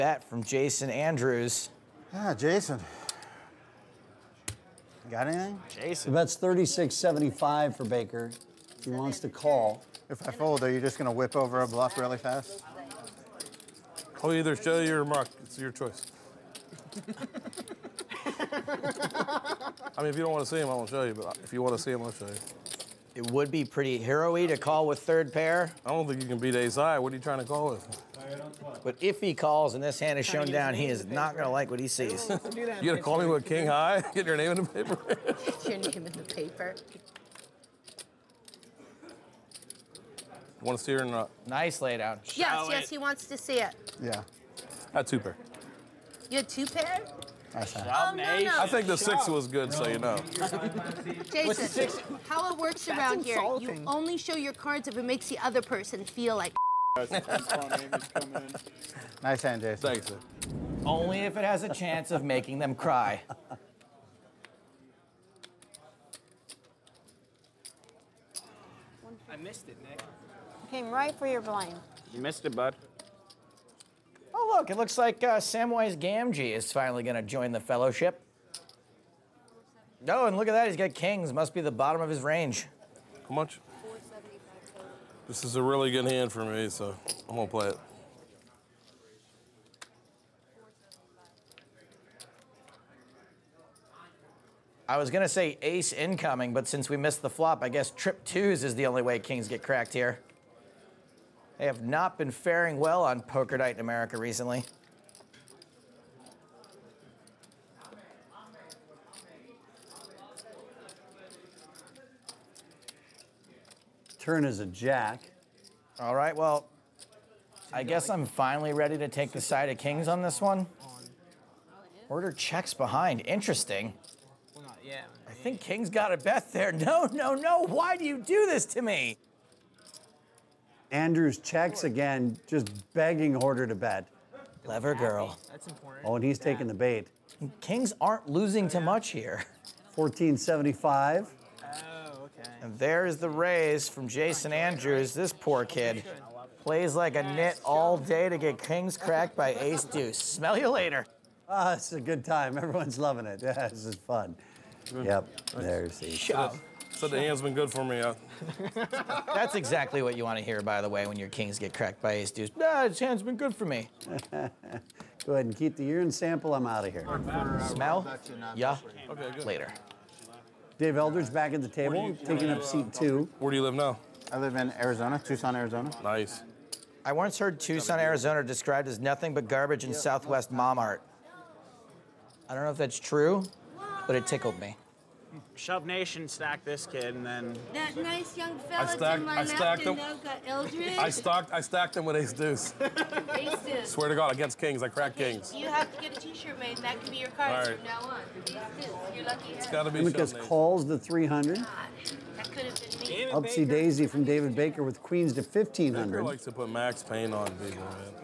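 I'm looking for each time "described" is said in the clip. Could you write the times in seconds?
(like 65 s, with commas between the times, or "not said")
178 s.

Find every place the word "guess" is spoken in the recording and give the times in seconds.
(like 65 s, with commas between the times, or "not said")
97 s, 117 s.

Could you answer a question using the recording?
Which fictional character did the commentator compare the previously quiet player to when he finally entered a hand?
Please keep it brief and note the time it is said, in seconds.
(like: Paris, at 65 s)
Samwise Gamgee, at 75 s.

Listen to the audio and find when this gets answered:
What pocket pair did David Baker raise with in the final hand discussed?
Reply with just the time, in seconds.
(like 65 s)
205 s.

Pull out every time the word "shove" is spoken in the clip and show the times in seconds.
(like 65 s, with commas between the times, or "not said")
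156 s, 185 s.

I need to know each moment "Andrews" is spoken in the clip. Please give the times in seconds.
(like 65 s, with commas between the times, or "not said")
0 s, 130 s, 144 s.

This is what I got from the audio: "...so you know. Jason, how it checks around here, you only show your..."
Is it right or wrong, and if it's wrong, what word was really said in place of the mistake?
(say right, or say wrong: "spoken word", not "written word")
wrong: "works", not "checks".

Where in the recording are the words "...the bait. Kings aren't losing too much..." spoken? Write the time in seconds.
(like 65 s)
136 s.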